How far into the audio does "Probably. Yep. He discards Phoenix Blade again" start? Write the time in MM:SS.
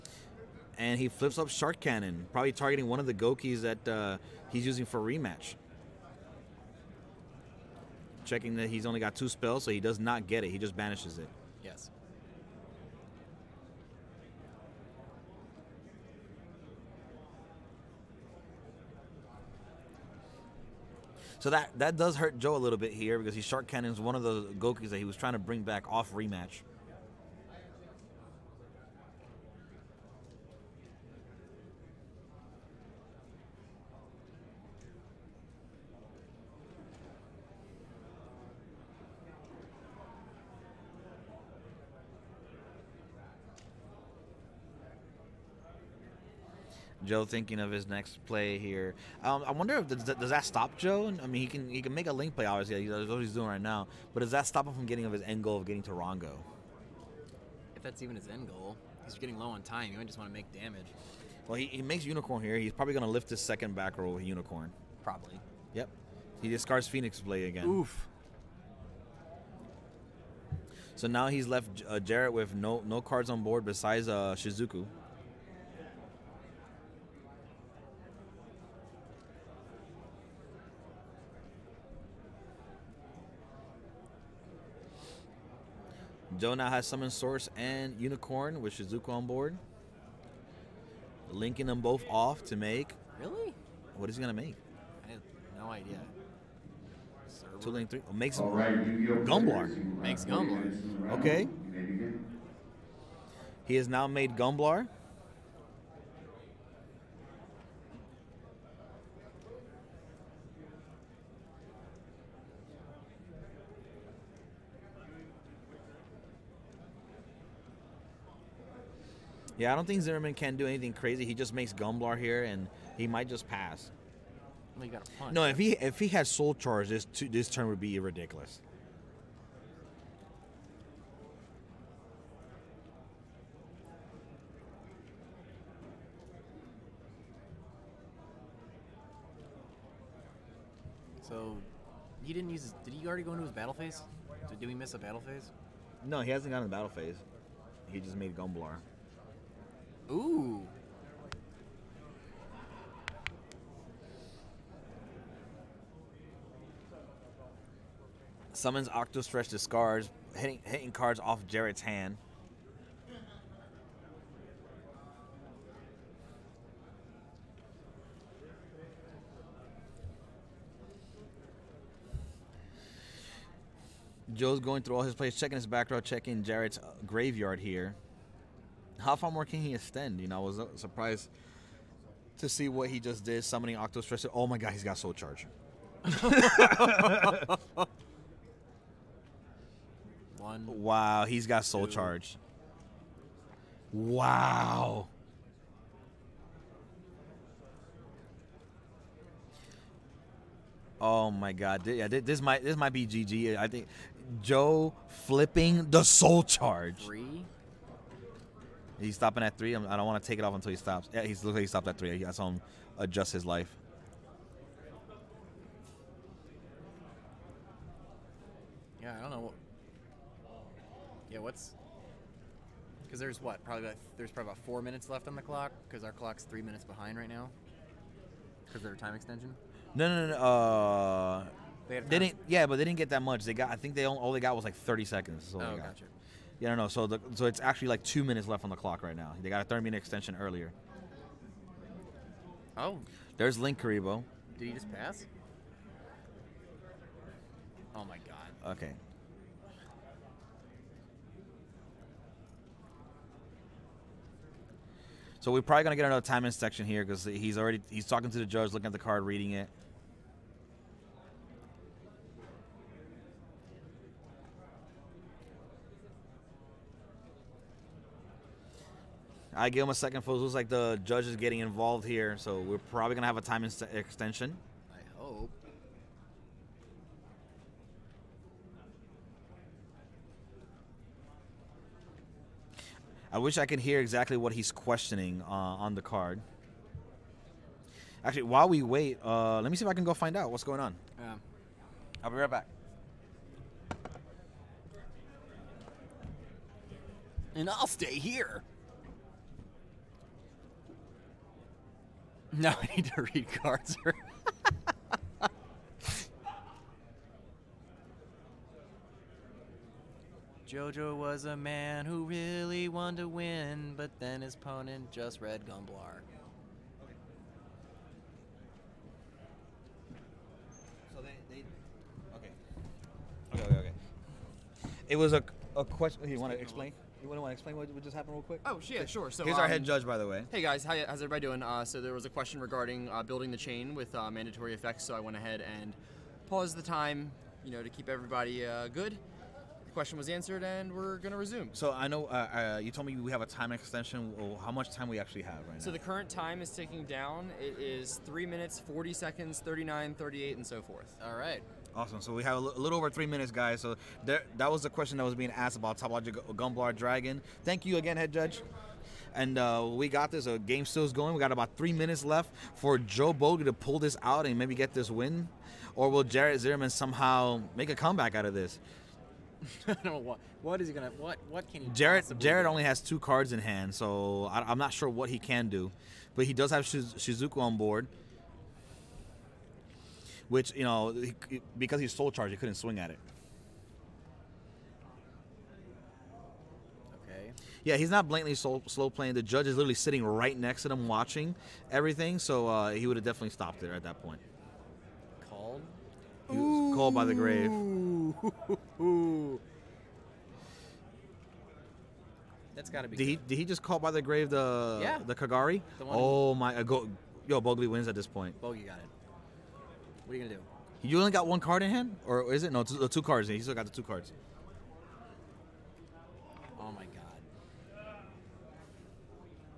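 01:05.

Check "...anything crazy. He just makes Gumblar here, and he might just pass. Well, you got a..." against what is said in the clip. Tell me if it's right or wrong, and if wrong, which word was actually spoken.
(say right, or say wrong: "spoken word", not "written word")
right.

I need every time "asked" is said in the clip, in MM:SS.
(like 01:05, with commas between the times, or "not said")
05:55.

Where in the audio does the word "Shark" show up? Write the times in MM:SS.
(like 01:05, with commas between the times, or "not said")
00:01, 00:23.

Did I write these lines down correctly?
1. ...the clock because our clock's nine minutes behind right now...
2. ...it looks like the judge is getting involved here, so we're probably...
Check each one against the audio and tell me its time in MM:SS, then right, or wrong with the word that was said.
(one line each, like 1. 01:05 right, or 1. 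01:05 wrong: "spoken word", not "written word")
1. 03:45 wrong: "three", not "nine"
2. 04:30 right.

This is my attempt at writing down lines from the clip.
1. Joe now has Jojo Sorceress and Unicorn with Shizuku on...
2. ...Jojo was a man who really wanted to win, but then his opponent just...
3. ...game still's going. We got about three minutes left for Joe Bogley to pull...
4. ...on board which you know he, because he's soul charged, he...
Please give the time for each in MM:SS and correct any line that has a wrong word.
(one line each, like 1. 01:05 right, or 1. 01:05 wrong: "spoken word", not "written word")
1. 01:26 wrong: "Summon", not "Jojo"
2. 05:10 right
3. 06:00 right
4. 06:17 right.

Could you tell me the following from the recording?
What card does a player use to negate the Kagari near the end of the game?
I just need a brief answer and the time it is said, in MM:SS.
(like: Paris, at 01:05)
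Called by the Grave, at 06:36.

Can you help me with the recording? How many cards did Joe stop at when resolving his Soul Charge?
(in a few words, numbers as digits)
3.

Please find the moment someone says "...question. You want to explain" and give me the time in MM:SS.
05:25.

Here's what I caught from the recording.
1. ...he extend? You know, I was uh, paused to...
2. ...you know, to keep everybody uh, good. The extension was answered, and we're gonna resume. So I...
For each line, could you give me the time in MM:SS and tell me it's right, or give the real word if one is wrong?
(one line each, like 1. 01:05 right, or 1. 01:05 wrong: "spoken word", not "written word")
1. 02:59 wrong: "surprised", not "paused"
2. 05:37 wrong: "question", not "extension".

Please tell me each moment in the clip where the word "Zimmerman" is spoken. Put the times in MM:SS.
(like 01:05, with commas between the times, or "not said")
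02:00, 06:06.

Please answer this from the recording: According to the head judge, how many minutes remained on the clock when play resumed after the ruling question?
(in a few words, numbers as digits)
3 minutes 40 seconds.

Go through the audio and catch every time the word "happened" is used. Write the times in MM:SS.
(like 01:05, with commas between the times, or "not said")
05:28.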